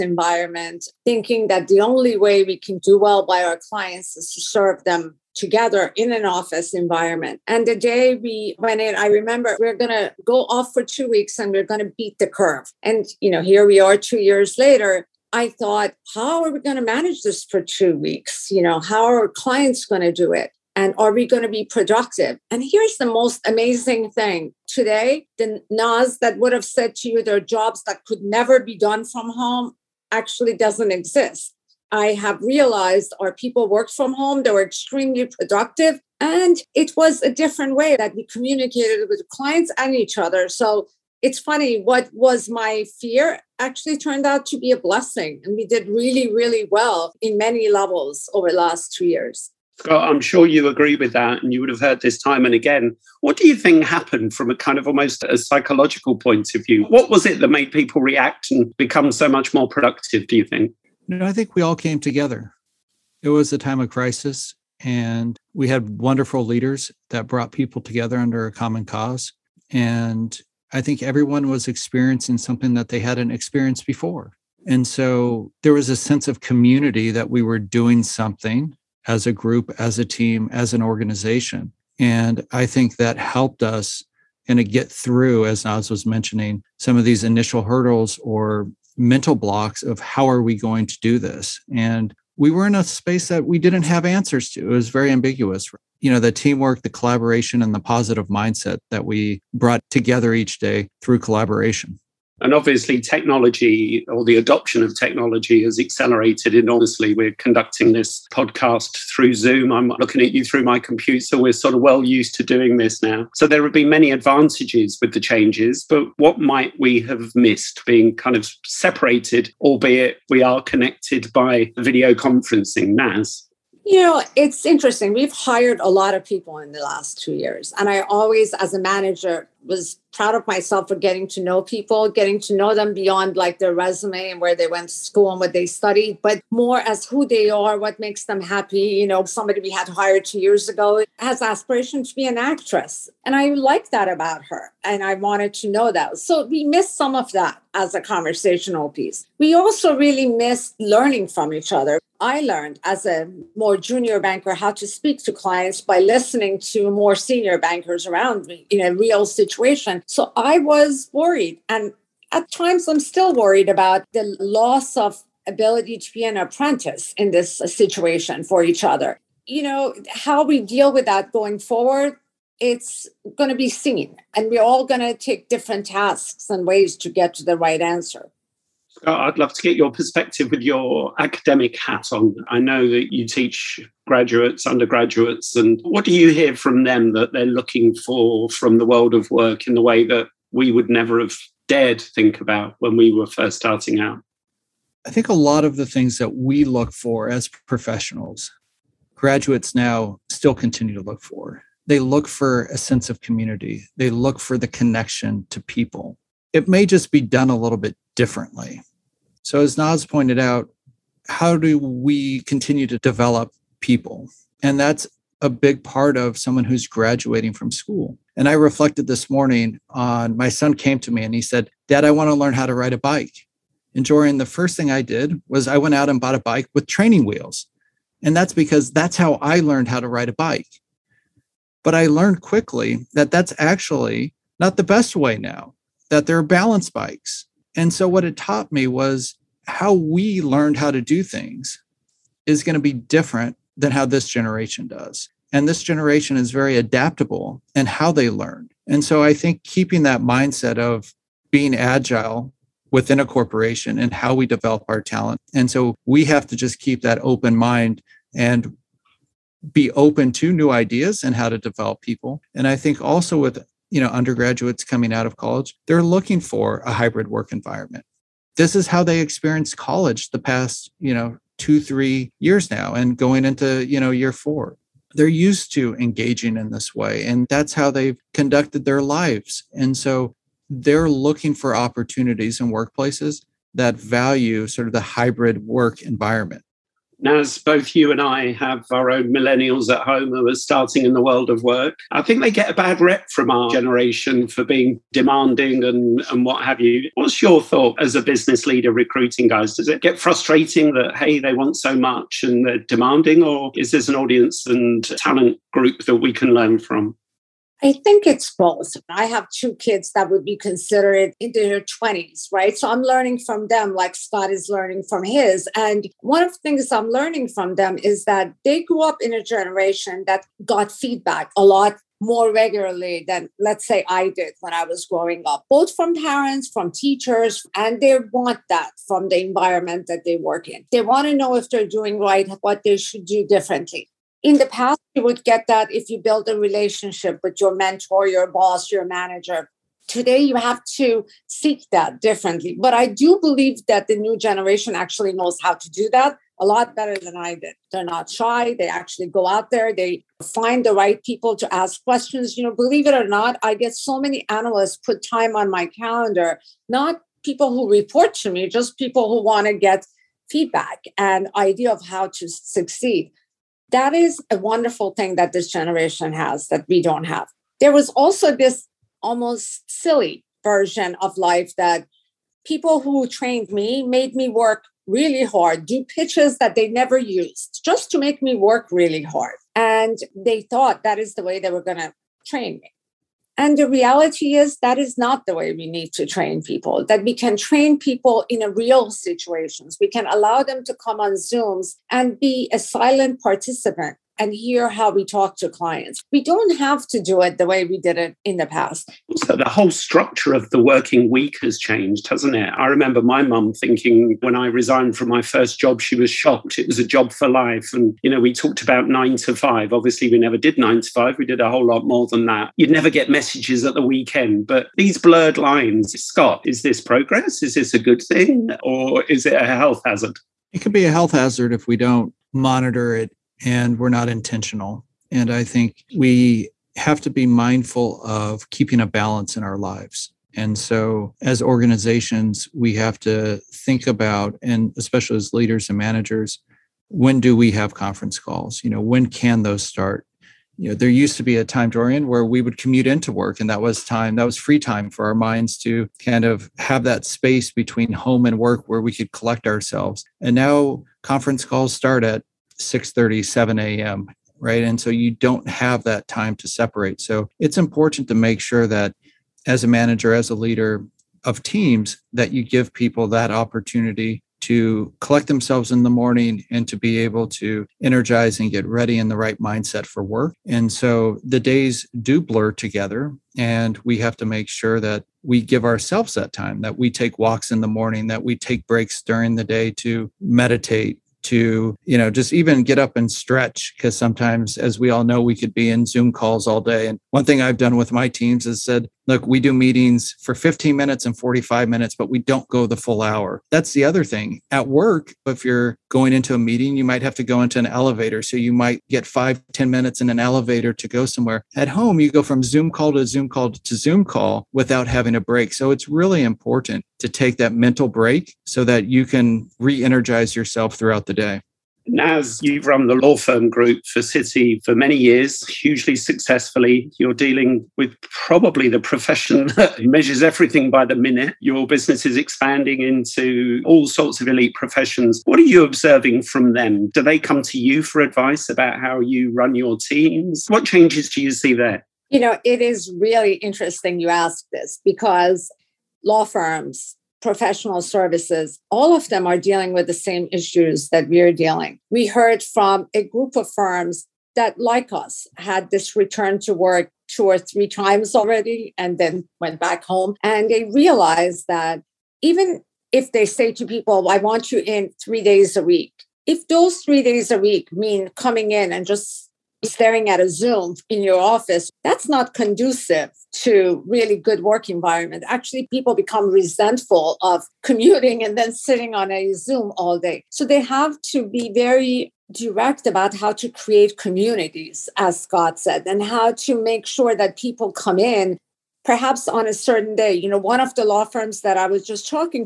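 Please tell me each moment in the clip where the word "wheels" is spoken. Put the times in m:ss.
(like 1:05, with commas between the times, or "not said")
3:47.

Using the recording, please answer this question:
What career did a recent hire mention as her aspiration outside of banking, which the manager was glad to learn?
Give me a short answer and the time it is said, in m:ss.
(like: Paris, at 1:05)
Actress, at 2:22.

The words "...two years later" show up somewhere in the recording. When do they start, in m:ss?
0:13.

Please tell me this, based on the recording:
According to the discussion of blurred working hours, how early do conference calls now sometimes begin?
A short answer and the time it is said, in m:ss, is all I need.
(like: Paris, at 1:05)
6:30, at 7:32.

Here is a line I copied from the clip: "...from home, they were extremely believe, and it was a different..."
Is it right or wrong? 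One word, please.
wrong.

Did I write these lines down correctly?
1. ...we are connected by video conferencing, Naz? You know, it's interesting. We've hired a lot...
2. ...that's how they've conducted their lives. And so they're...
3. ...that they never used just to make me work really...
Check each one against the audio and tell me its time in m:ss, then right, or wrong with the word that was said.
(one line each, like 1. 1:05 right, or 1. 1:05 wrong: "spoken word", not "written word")
1. 2:00 right
2. 4:37 right
3. 6:16 right.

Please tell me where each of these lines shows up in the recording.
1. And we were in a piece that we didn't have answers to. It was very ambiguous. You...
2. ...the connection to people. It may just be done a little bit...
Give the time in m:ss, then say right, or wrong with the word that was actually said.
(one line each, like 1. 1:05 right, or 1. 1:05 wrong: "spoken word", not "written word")
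1. 1:31 wrong: "space", not "piece"
2. 3:24 right.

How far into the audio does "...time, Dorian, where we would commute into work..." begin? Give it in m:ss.
7:21.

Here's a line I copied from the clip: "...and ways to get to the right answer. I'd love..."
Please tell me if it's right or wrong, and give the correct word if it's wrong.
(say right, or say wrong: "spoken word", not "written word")
right.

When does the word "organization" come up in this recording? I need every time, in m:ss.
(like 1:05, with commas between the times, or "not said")
1:20, 7:11.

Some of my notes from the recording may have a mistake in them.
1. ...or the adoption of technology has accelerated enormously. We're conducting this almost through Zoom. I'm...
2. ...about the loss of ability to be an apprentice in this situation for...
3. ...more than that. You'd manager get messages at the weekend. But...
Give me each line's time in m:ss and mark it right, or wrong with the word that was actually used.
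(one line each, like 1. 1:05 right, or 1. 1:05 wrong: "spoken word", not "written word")
1. 1:44 wrong: "podcast", not "almost"
2. 2:43 right
3. 6:52 wrong: "never", not "manager".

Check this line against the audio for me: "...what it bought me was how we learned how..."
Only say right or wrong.
wrong.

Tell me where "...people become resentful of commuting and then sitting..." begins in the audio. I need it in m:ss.
9:25.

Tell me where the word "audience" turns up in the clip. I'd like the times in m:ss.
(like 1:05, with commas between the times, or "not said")
5:04.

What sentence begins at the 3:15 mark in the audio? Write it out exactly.
I think a lot of the things that we look for as professionals, graduates now still continue to look for.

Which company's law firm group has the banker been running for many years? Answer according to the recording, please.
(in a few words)
Citi.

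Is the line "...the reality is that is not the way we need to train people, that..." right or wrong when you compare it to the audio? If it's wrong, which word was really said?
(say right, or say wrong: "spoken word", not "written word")
right.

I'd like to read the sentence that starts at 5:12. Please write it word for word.
So I'm learning from them like Scott is learning from his.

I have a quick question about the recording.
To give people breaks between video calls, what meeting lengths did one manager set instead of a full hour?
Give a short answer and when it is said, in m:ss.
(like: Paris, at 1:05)
15 and 45 minutes, at 8:10.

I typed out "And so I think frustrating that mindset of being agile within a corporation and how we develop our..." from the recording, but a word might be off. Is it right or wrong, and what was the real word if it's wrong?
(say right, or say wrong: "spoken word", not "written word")
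wrong: "keeping", not "frustrating".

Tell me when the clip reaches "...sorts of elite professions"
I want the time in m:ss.
8:44.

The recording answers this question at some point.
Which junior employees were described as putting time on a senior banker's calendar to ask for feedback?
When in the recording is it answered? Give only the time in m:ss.
5:54.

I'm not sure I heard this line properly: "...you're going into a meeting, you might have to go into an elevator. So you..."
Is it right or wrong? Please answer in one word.
right.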